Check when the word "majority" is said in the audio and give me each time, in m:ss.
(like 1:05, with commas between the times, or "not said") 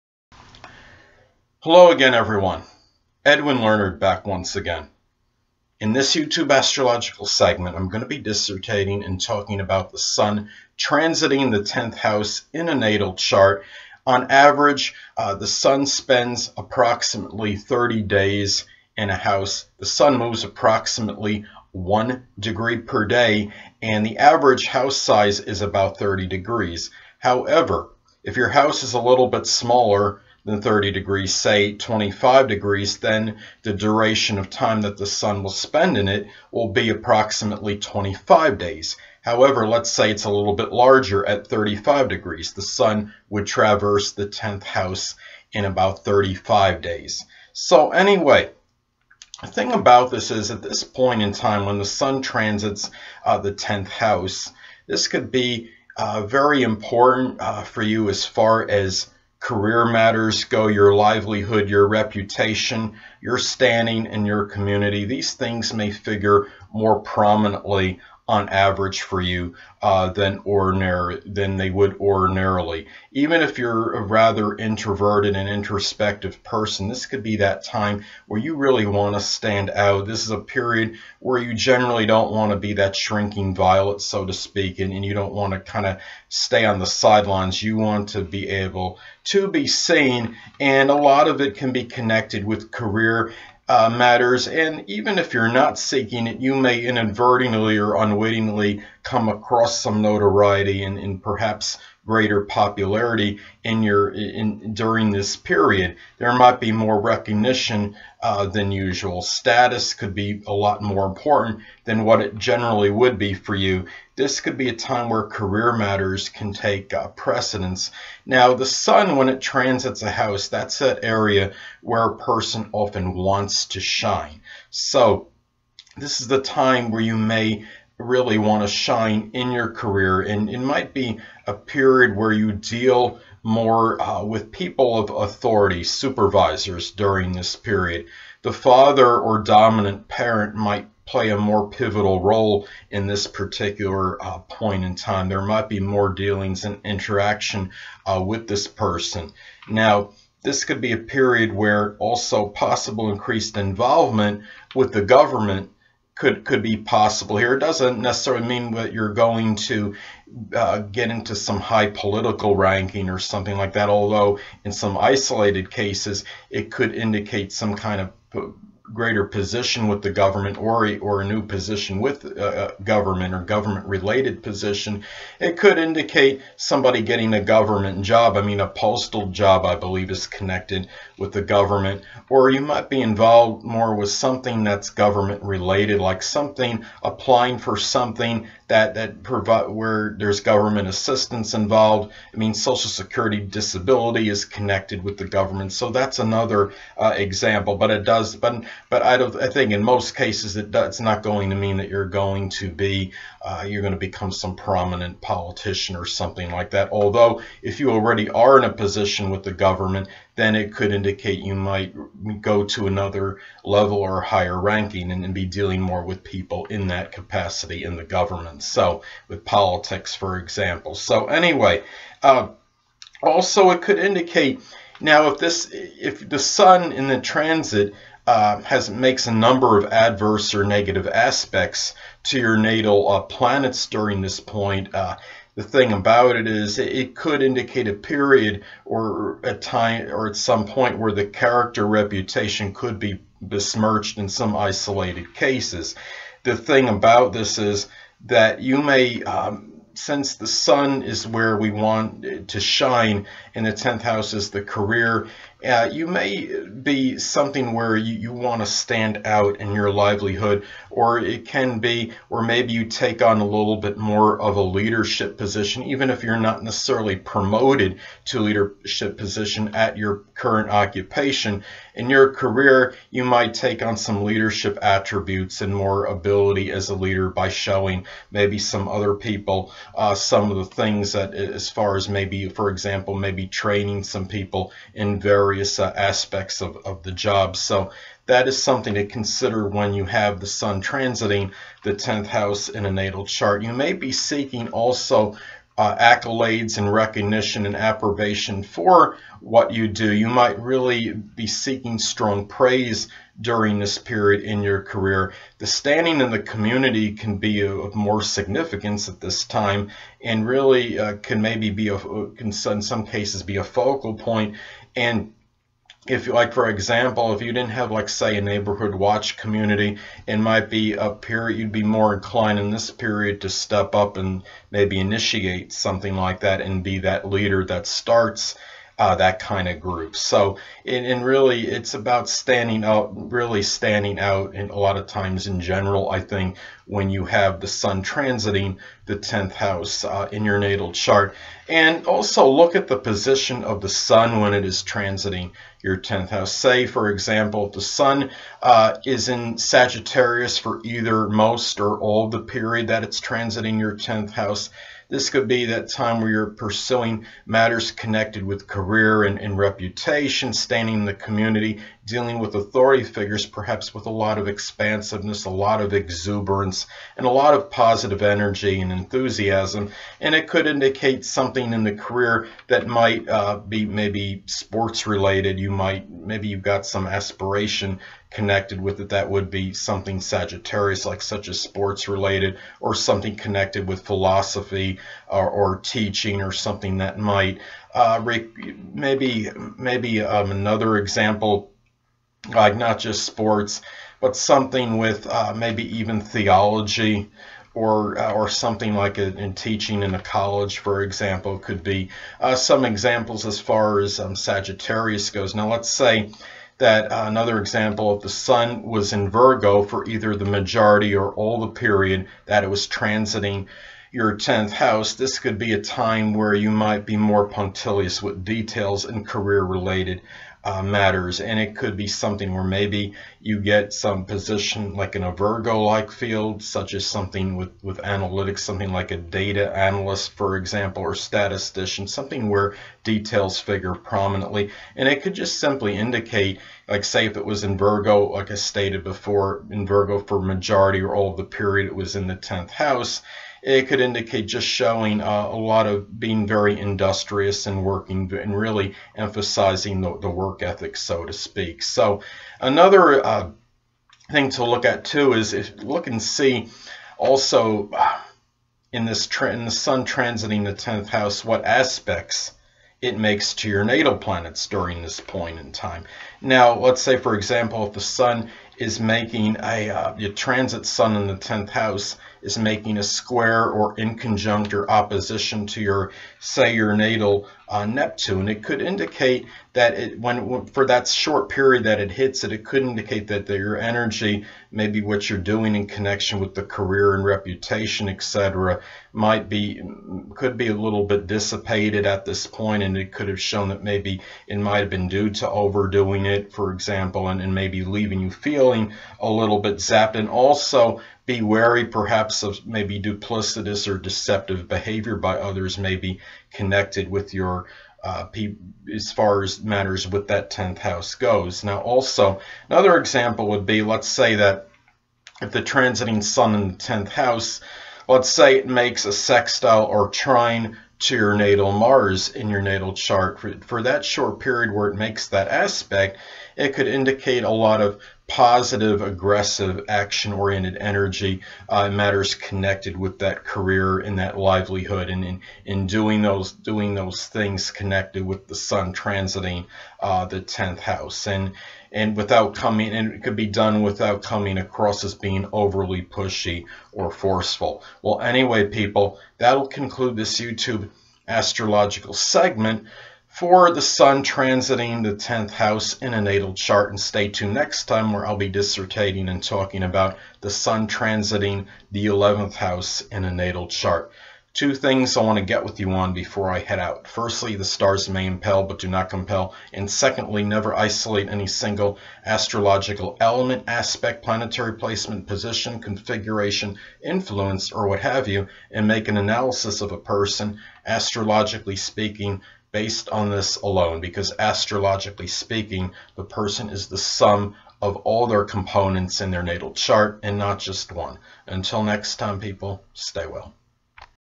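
6:50, 7:20.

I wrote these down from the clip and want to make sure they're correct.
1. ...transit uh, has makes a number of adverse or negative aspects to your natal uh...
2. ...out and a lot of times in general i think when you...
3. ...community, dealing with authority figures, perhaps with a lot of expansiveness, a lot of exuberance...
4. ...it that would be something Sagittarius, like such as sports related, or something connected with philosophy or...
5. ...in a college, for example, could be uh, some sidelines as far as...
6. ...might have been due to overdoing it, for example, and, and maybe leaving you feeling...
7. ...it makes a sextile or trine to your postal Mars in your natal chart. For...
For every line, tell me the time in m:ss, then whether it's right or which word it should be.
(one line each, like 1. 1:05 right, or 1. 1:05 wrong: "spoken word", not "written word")
1. 3:47 right
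2. 5:34 right
3. 6:01 right
4. 6:18 right
5. 6:40 wrong: "examples", not "sidelines"
6. 8:14 right
7. 8:38 wrong: "natal", not "postal".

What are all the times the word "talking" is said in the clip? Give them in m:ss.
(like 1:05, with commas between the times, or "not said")
0:09, 9:19.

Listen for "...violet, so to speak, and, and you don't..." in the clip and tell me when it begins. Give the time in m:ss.
1:23.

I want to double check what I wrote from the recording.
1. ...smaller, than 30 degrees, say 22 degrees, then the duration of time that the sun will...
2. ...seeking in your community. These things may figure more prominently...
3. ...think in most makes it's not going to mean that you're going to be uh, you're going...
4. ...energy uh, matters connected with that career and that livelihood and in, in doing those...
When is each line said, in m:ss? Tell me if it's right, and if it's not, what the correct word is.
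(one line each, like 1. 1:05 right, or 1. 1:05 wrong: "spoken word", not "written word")
1. 0:29 wrong: "25", not "22"
2. 1:03 wrong: "standing", not "seeking"
3. 3:19 wrong: "cases", not "makes"
4. 8:50 right.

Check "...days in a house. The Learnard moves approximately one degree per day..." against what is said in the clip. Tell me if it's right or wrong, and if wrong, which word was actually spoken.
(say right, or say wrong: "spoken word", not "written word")
wrong: "Sun", not "Learnard".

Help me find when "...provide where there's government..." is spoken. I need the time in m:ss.
3:09.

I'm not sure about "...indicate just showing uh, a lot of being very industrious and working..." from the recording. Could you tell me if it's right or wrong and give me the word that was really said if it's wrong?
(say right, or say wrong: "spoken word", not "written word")
right.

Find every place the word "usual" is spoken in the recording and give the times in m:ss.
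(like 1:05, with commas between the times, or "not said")
1:48.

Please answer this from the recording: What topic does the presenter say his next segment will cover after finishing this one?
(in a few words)
Sun transiting the 11th house.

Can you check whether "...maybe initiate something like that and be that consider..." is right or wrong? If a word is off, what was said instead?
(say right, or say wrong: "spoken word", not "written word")
wrong: "leader", not "consider".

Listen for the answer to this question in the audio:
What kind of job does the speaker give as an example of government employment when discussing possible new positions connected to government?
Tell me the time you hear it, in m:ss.
2:58.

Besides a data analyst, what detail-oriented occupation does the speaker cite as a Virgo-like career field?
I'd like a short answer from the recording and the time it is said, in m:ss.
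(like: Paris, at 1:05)
statistician, at 7:11.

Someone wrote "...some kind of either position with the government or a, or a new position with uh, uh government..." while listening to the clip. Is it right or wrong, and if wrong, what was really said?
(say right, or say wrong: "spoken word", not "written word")
wrong: "greater", not "either".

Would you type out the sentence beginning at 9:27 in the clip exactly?
Firstly, the stars may impel but do not compel.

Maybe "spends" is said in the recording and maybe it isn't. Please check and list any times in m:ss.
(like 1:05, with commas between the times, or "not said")
0:15, 0:35.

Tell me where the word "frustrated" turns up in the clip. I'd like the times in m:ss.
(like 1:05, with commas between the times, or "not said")
not said.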